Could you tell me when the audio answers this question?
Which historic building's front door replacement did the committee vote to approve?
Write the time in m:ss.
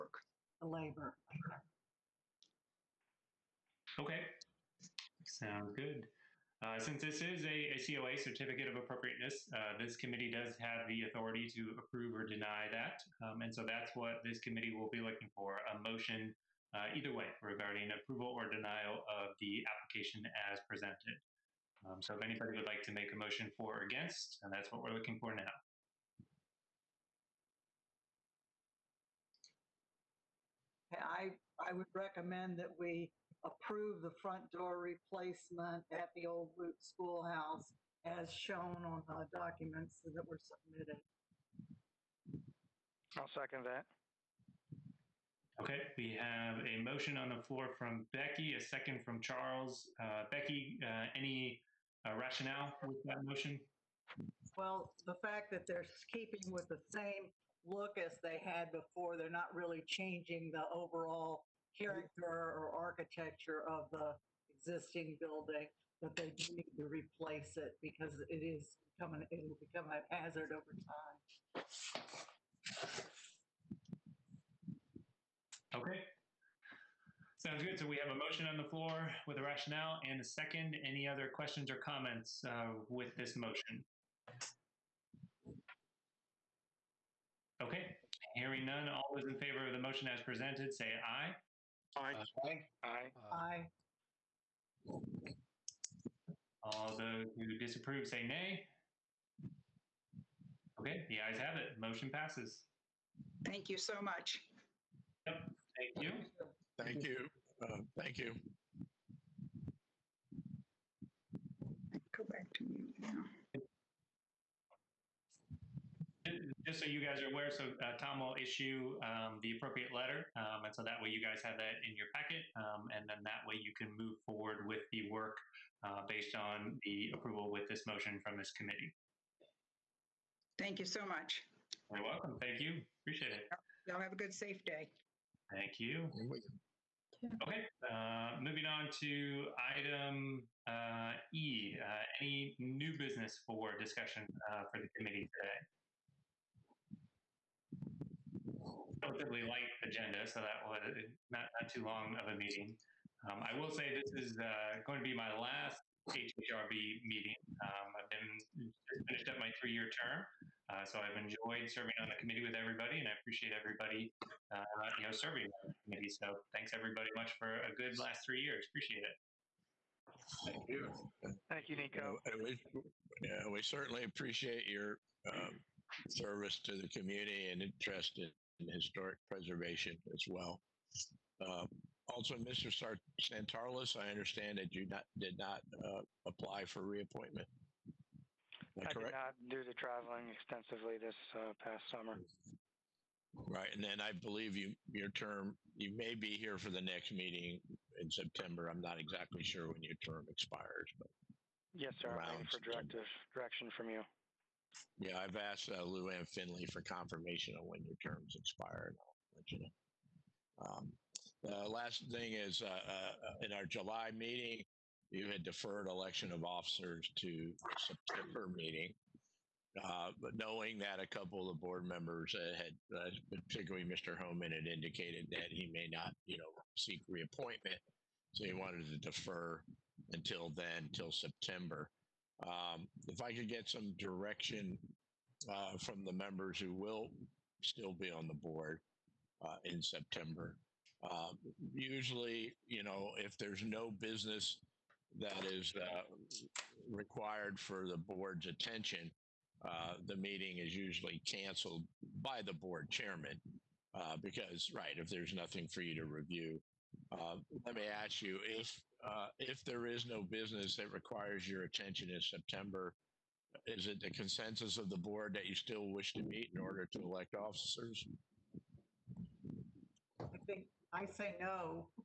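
0:36.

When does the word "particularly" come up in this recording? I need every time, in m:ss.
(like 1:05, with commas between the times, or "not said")
3:43.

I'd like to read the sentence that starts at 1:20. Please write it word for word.
Any other questions or comments uh, with this motion?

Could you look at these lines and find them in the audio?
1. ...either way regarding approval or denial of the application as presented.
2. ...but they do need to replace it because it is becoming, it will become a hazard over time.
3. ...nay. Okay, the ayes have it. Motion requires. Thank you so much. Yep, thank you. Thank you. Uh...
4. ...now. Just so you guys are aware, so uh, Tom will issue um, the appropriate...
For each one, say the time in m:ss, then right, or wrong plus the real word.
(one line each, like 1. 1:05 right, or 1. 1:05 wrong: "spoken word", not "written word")
1. 0:16 right
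2. 1:06 right
3. 1:38 wrong: "passes", not "requires"
4. 1:52 right.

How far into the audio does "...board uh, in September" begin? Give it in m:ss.
3:58.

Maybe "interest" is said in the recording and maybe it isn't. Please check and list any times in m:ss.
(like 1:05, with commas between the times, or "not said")
2:57.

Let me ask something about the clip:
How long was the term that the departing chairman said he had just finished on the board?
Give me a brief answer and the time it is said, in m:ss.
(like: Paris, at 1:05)
3 years, at 2:39.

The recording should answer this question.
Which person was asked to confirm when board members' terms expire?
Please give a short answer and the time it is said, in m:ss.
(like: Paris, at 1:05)
Lou Ann Finley, at 3:25.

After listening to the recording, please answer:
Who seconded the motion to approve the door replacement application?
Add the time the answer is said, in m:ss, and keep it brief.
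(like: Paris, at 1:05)
Charles, at 0:49.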